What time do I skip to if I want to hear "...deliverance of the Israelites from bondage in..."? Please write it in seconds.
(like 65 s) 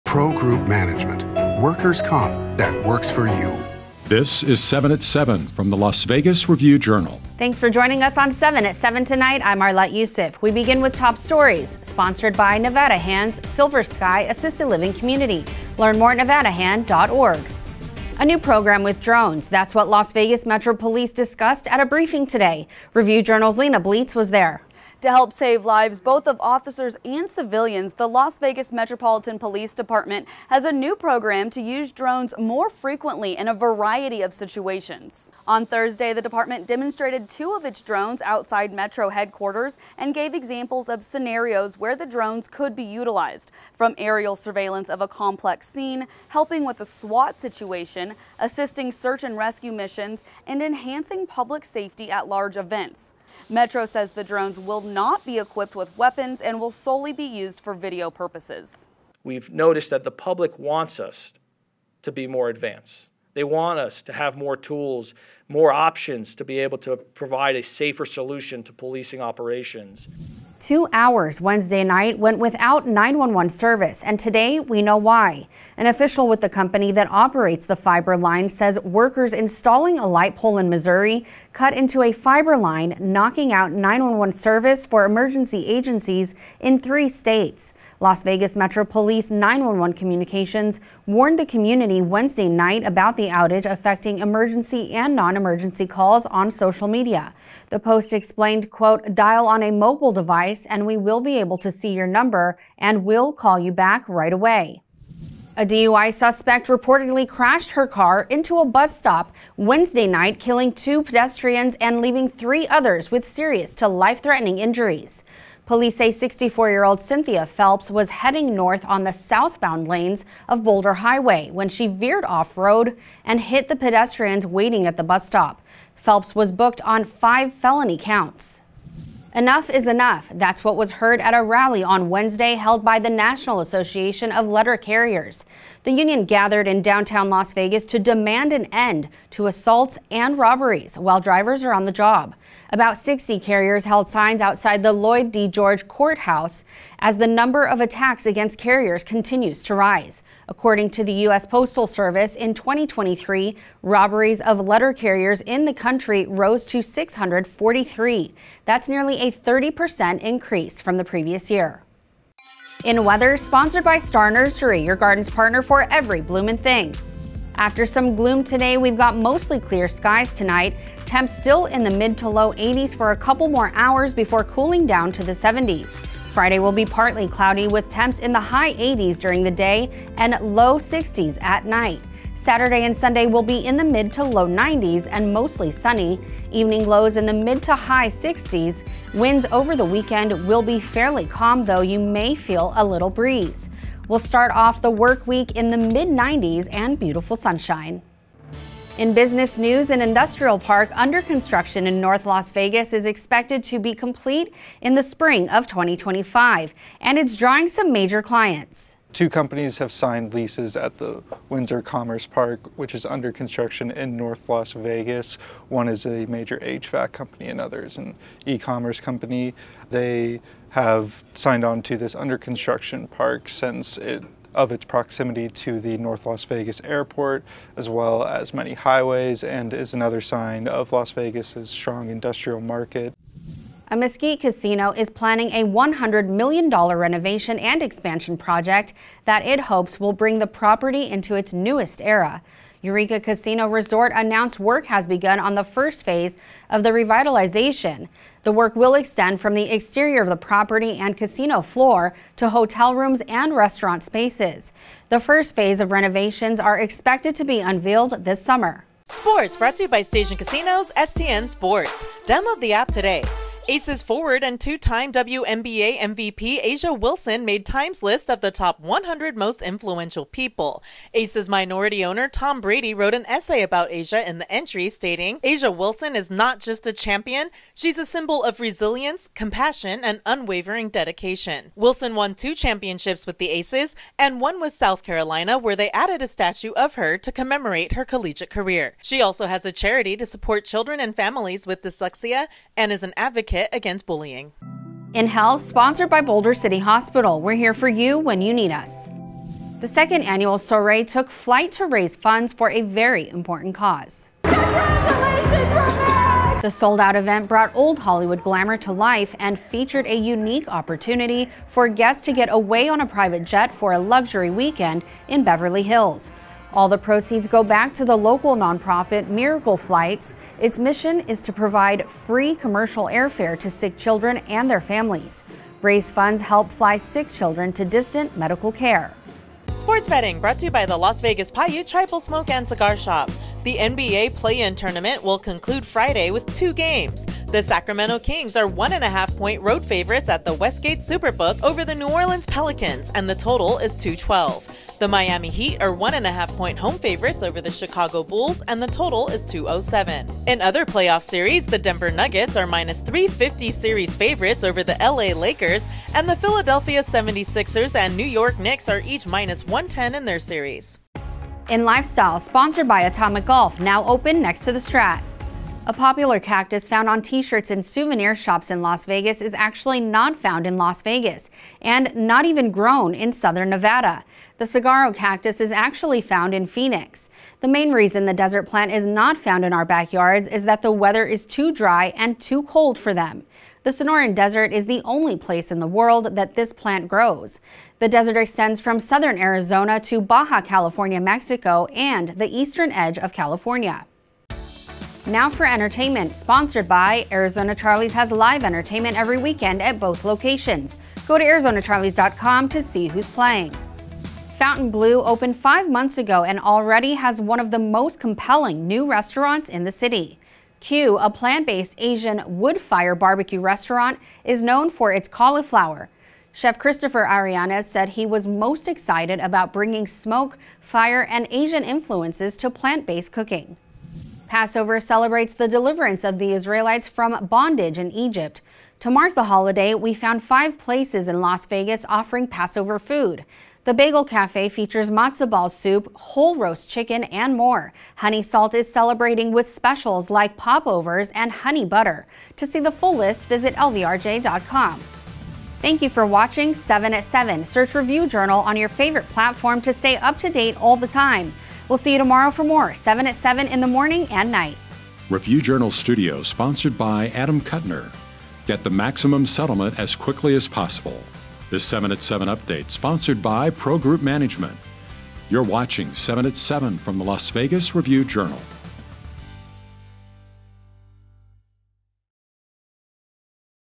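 425 s.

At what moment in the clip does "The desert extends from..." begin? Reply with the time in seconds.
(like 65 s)
387 s.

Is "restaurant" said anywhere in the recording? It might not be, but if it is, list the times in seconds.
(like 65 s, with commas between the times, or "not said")
253 s, 409 s, 413 s.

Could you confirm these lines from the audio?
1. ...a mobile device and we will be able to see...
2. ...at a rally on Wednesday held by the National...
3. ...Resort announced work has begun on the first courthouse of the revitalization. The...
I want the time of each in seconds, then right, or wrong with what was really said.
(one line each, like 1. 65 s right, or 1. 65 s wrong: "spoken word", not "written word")
1. 99 s right
2. 131 s right
3. 243 s wrong: "phase", not "courthouse".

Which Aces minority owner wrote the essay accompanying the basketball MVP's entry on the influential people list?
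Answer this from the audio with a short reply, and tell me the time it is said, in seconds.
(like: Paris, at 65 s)
Tom Brady, at 272 s.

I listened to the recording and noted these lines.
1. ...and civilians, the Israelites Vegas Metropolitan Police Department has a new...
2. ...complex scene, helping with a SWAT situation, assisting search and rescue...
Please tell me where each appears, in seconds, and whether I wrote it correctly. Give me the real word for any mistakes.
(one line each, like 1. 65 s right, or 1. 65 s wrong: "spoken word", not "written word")
1. 27 s wrong: "Las", not "Israelites"
2. 45 s right.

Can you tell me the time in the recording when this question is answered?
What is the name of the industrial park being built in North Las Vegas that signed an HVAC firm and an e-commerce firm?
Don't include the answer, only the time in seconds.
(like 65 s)
211 s.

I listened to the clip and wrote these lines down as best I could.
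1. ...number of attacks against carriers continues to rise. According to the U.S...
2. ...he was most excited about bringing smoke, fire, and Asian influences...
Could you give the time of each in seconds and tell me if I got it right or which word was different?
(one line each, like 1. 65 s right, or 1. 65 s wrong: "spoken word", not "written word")
1. 147 s right
2. 418 s right.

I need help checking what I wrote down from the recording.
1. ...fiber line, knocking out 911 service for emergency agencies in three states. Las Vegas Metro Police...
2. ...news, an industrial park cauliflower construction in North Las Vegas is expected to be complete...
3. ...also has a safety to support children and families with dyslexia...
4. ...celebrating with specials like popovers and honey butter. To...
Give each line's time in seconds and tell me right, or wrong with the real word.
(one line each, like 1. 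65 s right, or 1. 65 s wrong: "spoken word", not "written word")
1. 82 s right
2. 199 s wrong: "under", not "cauliflower"
3. 289 s wrong: "charity", not "safety"
4. 438 s right.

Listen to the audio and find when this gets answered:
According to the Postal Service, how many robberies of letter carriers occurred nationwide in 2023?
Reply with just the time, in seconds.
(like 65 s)
156 s.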